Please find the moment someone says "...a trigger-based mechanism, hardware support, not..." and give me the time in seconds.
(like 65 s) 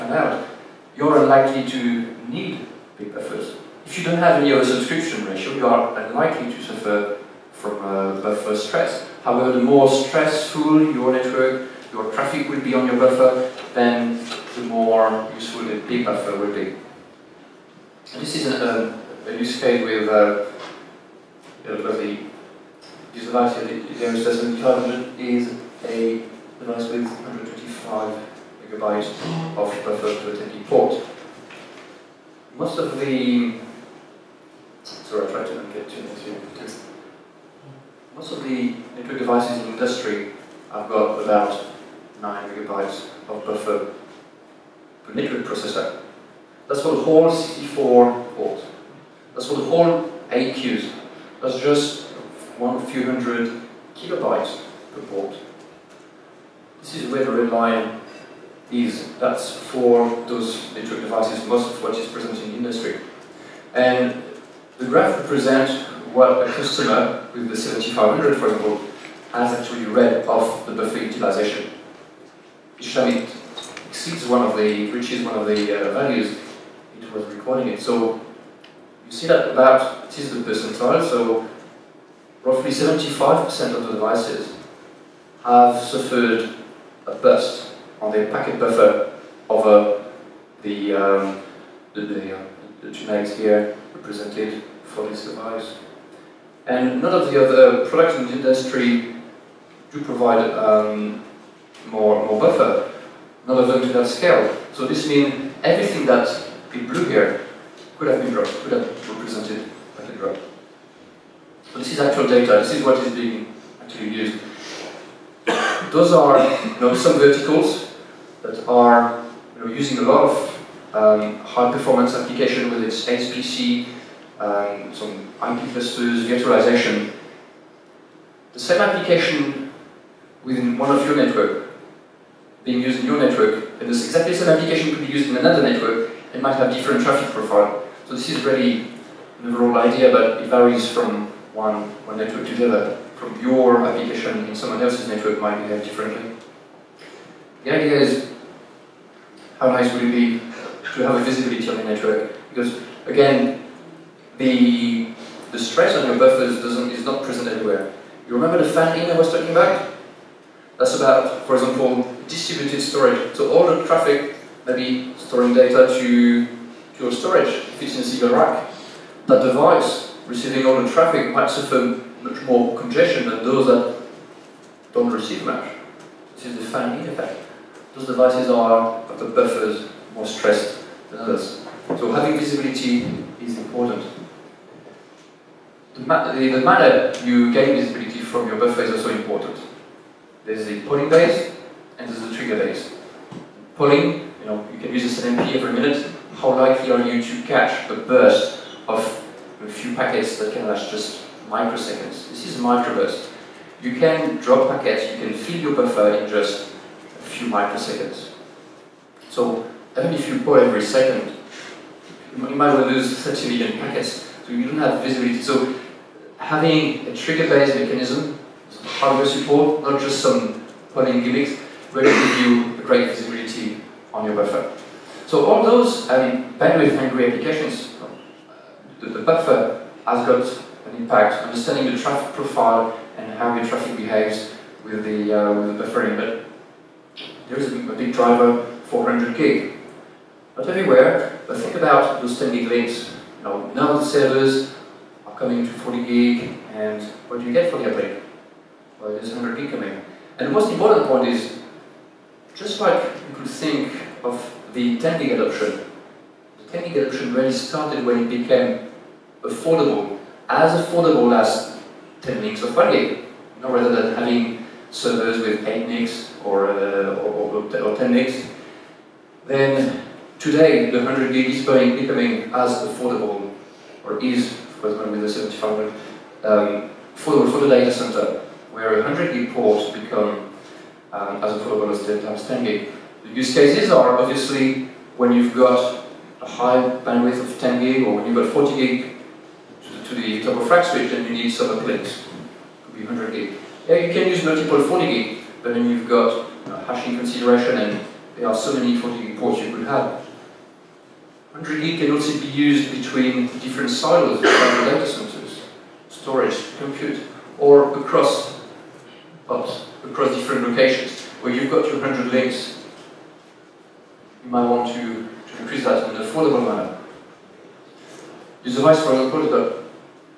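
217 s.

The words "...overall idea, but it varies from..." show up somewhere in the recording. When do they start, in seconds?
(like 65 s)
139 s.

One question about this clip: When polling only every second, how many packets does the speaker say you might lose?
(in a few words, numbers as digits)
30 million.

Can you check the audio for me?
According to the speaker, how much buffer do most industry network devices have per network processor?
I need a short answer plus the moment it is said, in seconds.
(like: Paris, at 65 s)
9 megabytes, at 42 s.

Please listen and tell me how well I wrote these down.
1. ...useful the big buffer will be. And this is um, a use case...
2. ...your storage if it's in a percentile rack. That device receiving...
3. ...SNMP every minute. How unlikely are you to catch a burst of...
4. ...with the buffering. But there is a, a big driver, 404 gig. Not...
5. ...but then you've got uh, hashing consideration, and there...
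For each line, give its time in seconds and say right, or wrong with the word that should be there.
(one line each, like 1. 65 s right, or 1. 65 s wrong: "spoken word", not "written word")
1. 15 s right
2. 166 s wrong: "single", not "percentile"
3. 195 s wrong: "likely", not "unlikely"
4. 235 s wrong: "400", not "404"
5. 295 s right.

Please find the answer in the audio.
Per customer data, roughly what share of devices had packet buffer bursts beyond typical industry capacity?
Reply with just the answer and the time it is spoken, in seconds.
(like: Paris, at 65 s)
75%, at 82 s.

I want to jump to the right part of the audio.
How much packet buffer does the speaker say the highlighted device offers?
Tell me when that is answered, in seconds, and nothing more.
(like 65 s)
27 s.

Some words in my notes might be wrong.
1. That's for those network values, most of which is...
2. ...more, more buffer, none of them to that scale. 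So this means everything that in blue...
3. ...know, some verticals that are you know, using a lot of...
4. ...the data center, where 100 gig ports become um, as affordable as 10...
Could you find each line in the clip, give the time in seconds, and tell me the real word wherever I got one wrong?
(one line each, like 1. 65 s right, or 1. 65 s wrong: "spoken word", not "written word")
1. 59 s wrong: "devices", not "values"
2. 101 s right
3. 116 s right
4. 277 s right.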